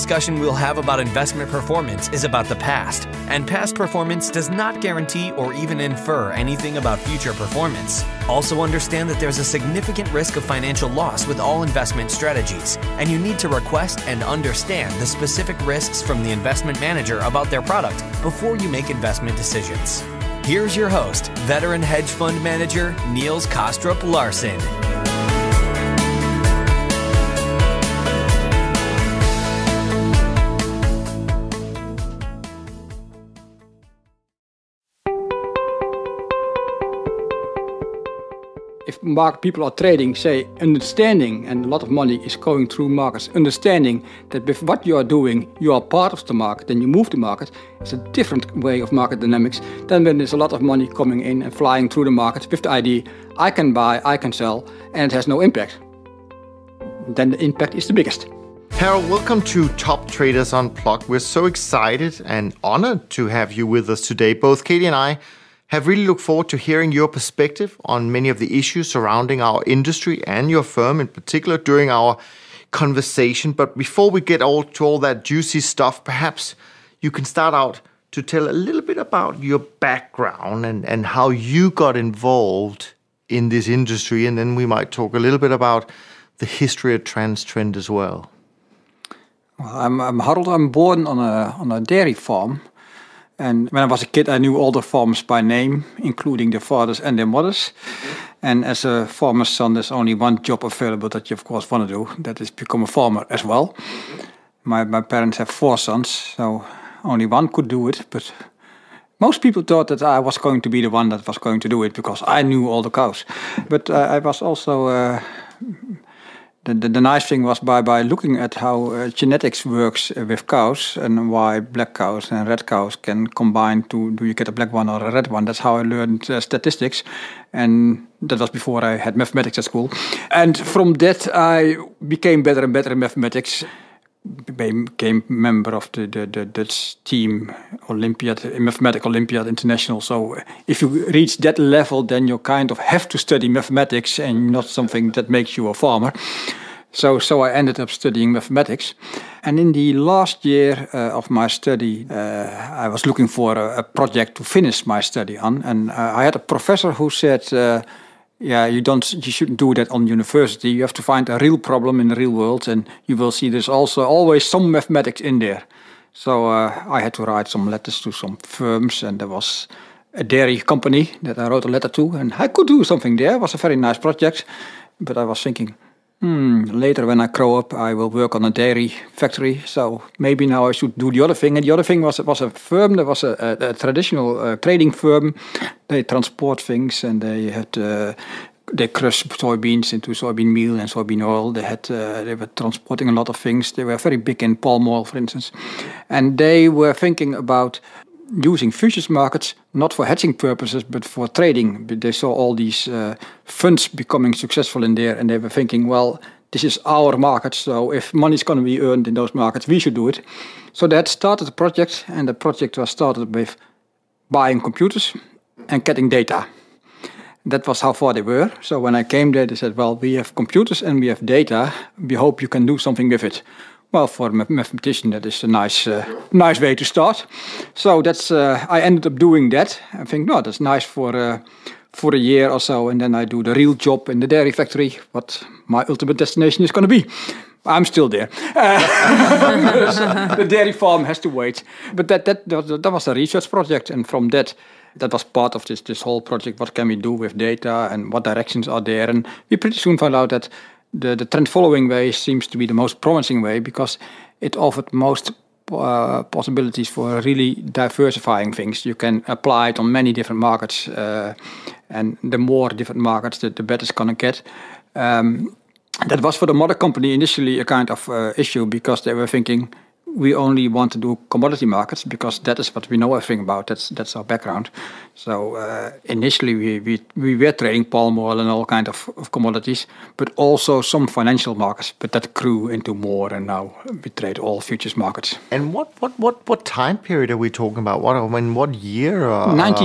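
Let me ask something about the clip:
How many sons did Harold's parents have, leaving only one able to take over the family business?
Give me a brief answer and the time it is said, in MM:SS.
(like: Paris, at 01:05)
4, at 01:45.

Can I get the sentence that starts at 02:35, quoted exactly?
And uh, I had a professor who said, uh, yeah, you don't, you shouldn't do that on university.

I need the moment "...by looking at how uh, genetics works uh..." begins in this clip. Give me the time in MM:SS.
01:57.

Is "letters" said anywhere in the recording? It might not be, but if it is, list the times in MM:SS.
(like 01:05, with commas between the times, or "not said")
02:47, 02:51.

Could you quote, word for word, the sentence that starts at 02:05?
That's how I learned uh, statistics, and that was before I had mathematics at school.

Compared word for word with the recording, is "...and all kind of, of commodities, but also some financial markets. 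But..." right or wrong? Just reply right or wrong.
right.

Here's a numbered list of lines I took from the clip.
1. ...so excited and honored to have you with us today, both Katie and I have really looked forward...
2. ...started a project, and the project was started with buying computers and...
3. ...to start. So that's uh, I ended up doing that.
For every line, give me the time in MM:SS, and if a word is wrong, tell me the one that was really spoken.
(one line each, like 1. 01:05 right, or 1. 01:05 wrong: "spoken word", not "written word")
1. 01:01 right
2. 03:31 right
3. 03:46 right.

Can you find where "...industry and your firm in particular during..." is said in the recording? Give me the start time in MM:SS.
01:09.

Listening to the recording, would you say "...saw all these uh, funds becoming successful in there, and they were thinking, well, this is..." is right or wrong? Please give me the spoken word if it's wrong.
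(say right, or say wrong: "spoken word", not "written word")
right.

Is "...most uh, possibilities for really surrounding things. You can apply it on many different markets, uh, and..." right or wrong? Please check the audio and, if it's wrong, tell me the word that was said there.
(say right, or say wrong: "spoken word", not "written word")
wrong: "diversifying", not "surrounding".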